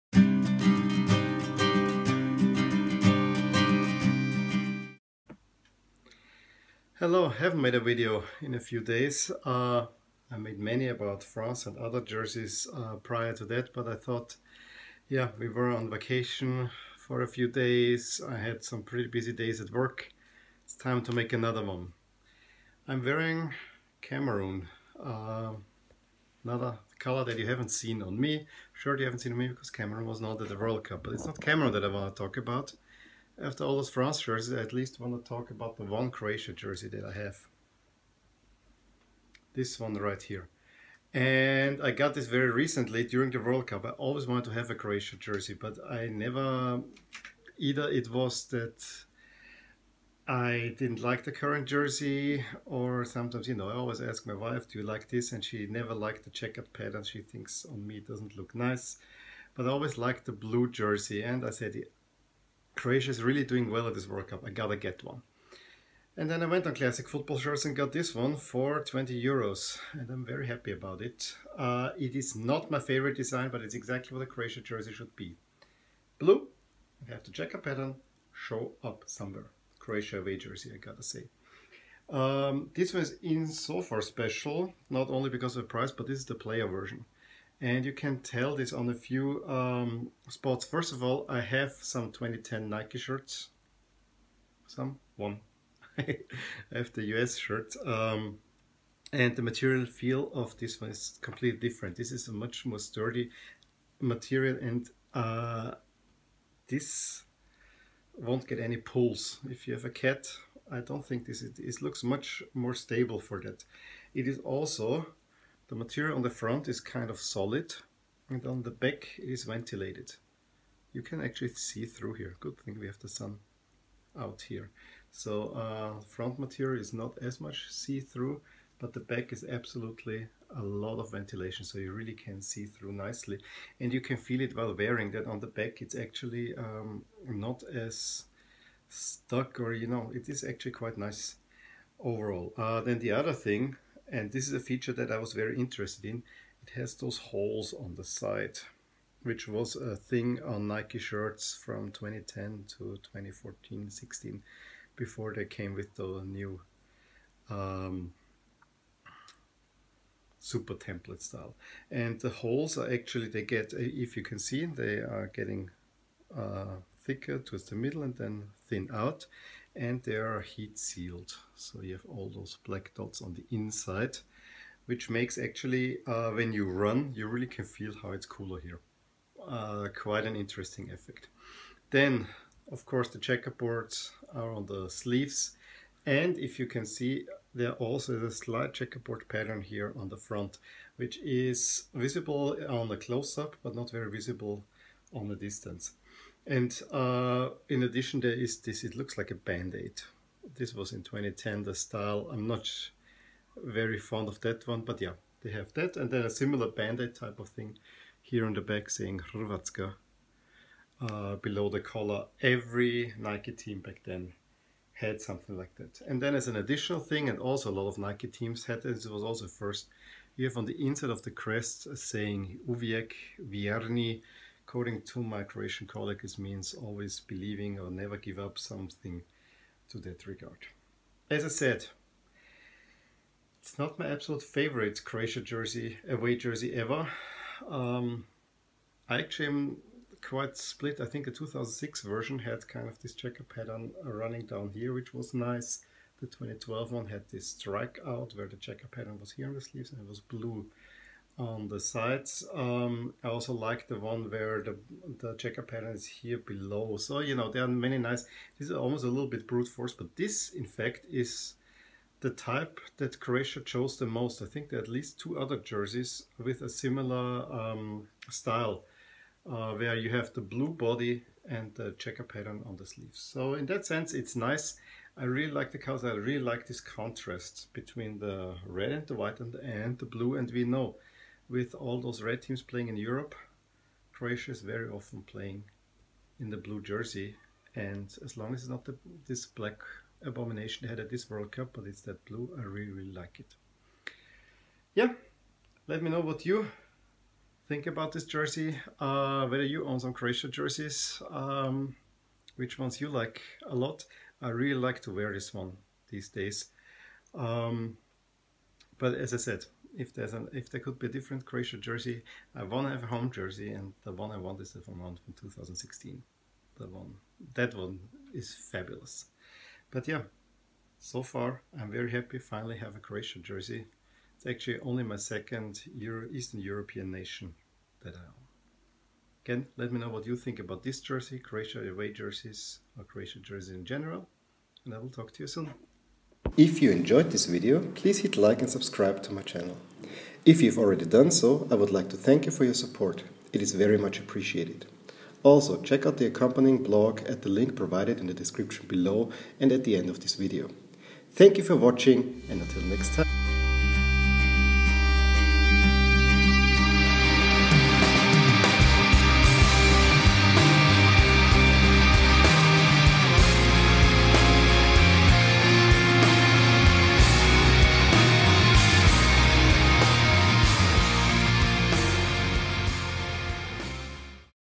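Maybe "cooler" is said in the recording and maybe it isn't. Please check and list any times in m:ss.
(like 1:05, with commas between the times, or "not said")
2:58.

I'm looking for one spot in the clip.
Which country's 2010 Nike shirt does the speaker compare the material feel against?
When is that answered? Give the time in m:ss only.
1:37.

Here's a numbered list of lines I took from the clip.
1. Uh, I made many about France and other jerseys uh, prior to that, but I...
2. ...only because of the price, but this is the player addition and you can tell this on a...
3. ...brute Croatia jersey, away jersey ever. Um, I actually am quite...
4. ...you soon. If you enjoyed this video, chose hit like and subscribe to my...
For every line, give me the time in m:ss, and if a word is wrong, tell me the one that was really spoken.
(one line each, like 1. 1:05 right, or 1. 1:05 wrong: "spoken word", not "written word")
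1. 0:09 right
2. 1:25 wrong: "version", not "addition"
3. 3:54 wrong: "favorite", not "brute"
4. 5:35 wrong: "please", not "chose".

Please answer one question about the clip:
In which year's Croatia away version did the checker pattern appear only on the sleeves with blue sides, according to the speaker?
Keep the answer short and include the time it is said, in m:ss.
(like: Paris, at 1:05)
2012, at 4:06.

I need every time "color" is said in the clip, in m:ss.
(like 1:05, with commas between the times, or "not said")
0:26, 4:35.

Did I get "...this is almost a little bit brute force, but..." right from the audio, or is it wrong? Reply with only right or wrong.
right.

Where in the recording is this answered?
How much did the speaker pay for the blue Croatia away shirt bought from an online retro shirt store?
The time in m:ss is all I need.
1:08.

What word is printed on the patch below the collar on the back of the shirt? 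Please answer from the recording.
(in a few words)
Hrvatska.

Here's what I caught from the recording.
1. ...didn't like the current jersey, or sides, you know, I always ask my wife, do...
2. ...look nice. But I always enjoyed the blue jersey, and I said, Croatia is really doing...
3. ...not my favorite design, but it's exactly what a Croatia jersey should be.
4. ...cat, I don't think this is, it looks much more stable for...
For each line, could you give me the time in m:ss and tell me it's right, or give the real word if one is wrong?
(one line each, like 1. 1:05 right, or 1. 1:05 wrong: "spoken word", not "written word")
1. 0:50 wrong: "sometimes", not "sides"
2. 0:58 wrong: "liked", not "enjoyed"
3. 1:12 right
4. 1:49 right.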